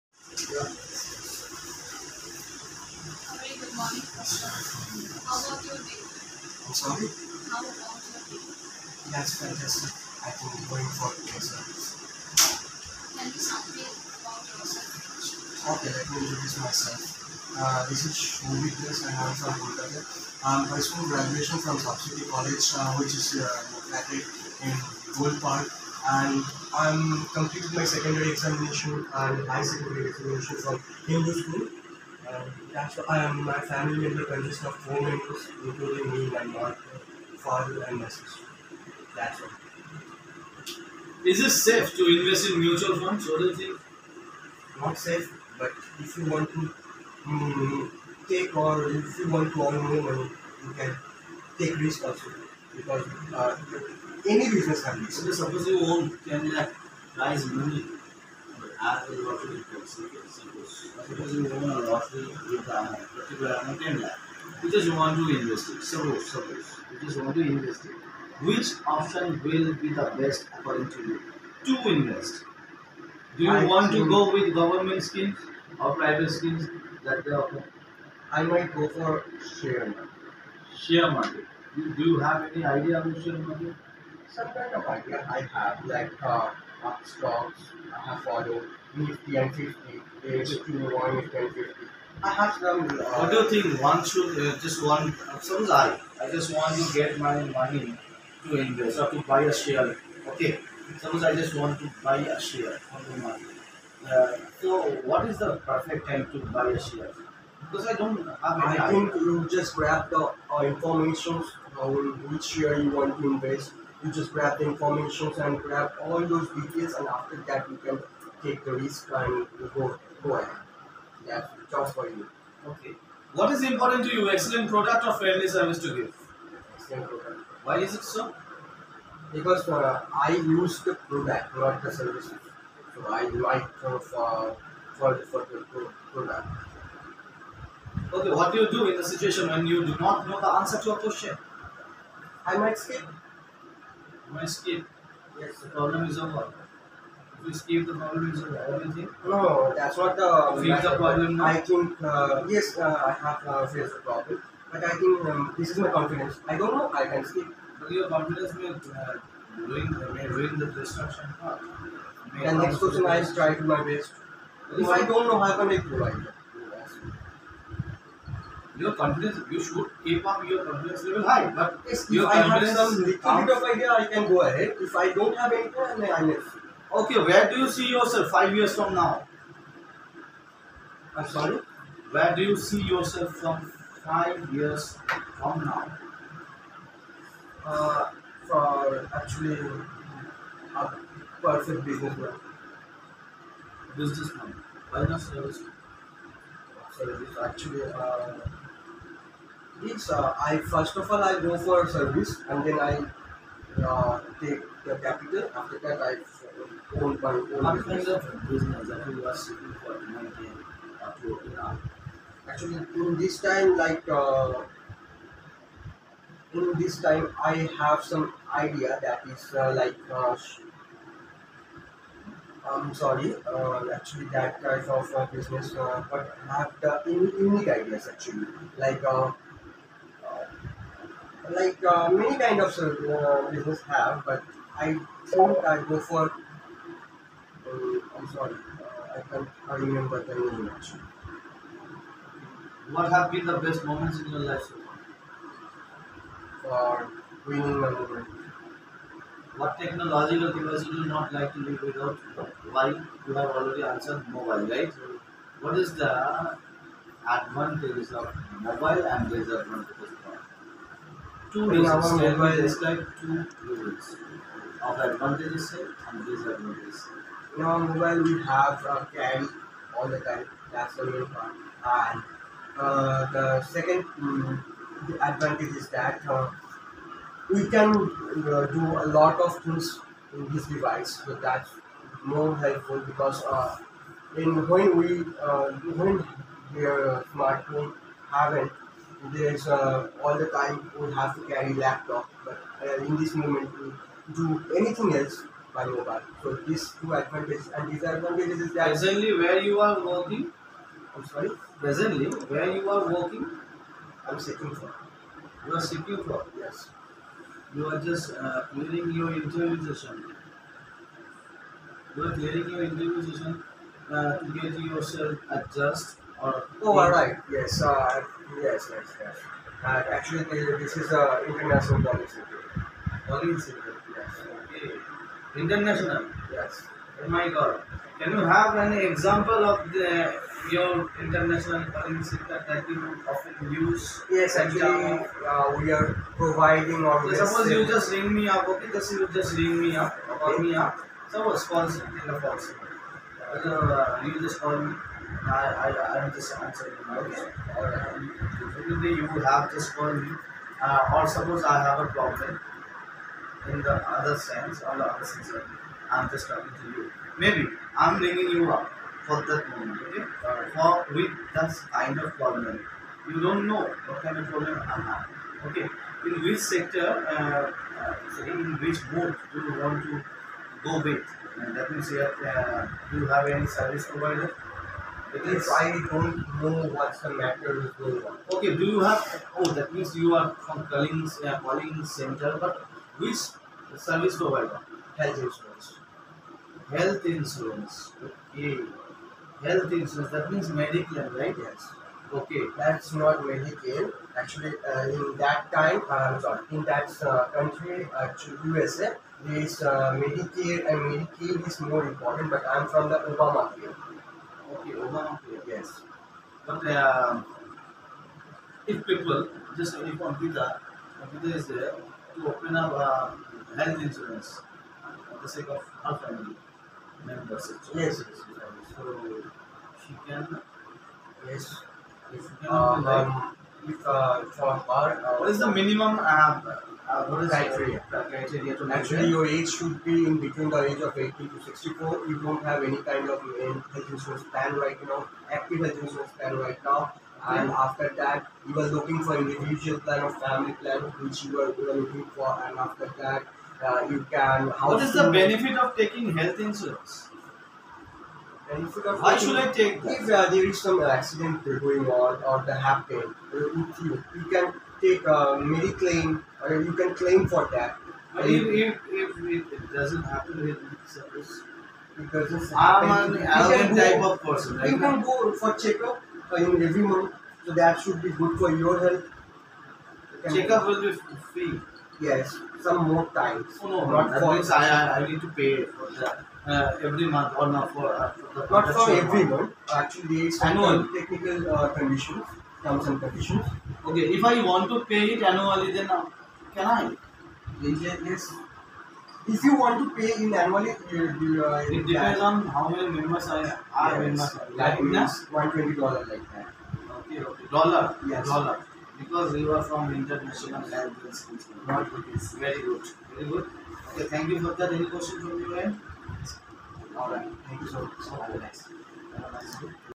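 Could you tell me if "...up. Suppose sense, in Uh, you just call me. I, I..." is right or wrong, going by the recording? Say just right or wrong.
wrong.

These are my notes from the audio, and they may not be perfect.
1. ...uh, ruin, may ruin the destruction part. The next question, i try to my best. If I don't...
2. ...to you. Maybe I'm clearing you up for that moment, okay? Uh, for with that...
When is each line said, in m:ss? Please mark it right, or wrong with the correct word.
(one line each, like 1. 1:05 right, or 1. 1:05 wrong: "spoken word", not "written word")
1. 2:38 right
2. 5:56 wrong: "bringing", not "clearing".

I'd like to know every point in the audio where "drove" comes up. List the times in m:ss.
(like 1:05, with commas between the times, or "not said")
not said.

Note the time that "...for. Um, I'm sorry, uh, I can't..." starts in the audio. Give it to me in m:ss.
3:55.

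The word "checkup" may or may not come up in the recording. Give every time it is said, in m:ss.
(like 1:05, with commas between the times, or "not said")
7:45, 7:50.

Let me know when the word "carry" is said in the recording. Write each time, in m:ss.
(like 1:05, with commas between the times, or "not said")
4:51.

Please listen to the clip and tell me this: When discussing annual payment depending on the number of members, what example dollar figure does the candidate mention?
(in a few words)
120 dollars.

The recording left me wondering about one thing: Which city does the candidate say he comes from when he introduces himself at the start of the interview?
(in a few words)
Kolkata.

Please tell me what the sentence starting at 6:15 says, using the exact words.
It means I don't know what's the matter with going on.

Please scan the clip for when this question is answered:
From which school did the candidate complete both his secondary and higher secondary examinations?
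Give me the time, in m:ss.
0:31.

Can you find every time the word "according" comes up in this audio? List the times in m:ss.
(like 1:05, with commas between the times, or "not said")
1:10.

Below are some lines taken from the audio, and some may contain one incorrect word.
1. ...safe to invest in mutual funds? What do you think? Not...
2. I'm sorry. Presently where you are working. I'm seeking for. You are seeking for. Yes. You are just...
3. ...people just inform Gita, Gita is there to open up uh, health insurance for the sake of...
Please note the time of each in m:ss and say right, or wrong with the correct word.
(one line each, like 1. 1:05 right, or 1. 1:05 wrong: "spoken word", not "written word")
1. 0:41 right
2. 5:01 right
3. 6:49 right.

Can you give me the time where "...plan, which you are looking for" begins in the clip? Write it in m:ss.
7:20.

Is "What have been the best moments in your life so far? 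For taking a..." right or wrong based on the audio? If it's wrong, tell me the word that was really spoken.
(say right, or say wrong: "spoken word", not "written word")
wrong: "winning", not "taking".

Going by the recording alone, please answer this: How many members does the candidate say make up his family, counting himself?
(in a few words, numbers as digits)
4.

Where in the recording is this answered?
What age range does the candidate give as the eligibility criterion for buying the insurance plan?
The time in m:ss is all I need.
7:11.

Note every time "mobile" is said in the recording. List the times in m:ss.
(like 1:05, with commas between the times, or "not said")
4:14, 4:18, 4:27, 4:55.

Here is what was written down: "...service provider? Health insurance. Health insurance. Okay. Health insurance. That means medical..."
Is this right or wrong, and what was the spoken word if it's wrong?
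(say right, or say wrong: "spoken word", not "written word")
right.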